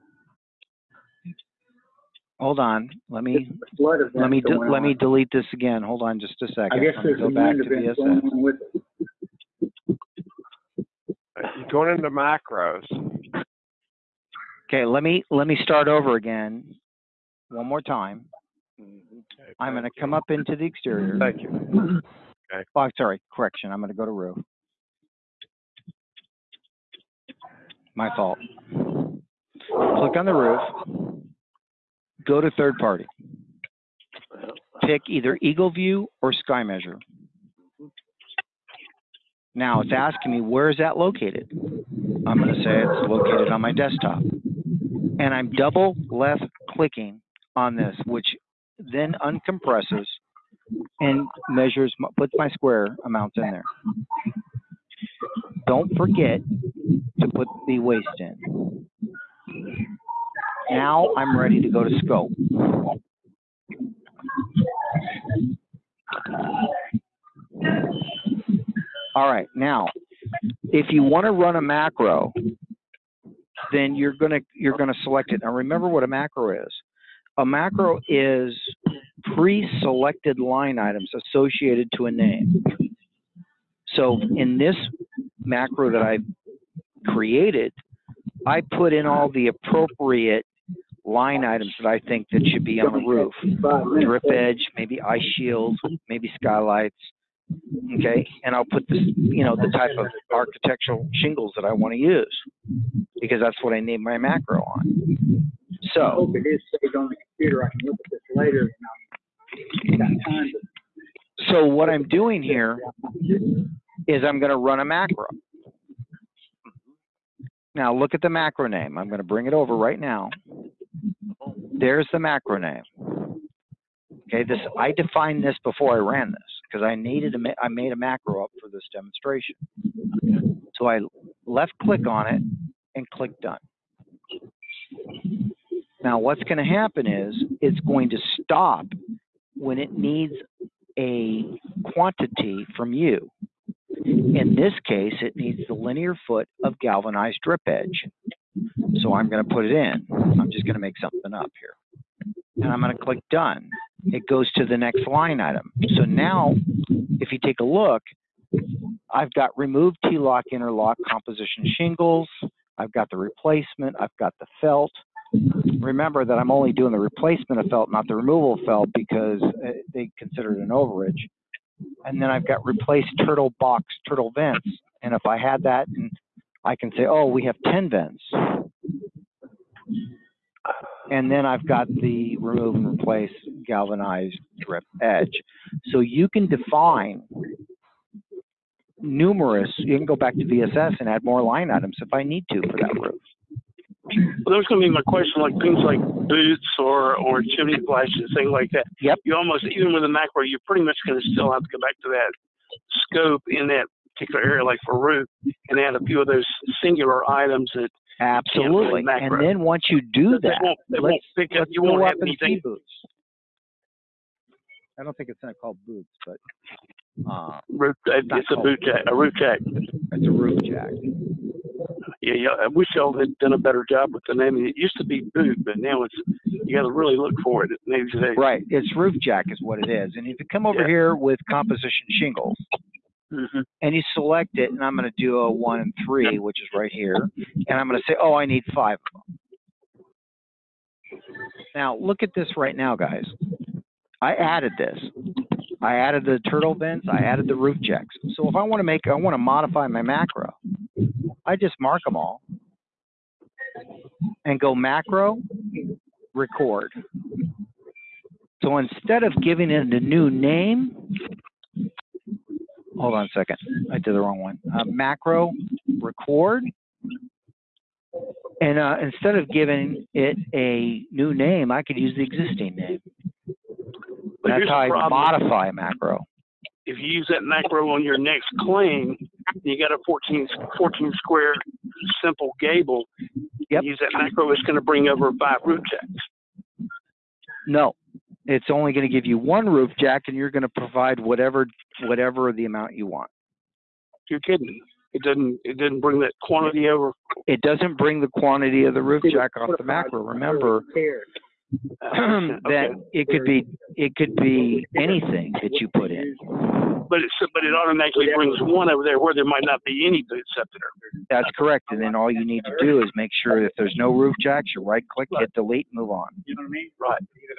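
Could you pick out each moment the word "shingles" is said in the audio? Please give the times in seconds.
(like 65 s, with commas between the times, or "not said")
101 s, 161 s, 232 s.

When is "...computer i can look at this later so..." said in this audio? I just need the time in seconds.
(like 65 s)
107 s.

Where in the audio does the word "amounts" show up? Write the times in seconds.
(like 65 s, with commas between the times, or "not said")
53 s, 292 s.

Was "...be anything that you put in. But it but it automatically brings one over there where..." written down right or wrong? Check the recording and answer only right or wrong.
right.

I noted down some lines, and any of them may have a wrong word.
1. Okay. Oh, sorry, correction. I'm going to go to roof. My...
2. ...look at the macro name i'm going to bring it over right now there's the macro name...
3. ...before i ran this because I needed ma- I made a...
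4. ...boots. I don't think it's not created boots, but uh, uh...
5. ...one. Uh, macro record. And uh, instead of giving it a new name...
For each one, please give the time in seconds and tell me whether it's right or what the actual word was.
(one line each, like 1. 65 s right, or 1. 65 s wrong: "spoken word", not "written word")
1. 22 s right
2. 117 s right
3. 125 s right
4. 212 s wrong: "called", not "created"
5. 264 s right.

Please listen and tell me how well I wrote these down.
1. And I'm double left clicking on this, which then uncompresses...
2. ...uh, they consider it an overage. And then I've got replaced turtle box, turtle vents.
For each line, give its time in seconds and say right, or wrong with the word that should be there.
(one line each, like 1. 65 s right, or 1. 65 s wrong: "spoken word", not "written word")
1. 45 s right
2. 169 s right.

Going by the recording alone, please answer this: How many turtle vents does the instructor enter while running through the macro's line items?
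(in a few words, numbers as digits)
10.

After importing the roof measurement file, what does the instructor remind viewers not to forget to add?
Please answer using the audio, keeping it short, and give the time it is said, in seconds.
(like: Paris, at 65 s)
The waste, at 57 s.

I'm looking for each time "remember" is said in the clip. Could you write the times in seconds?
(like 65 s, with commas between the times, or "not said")
75 s, 165 s, 300 s.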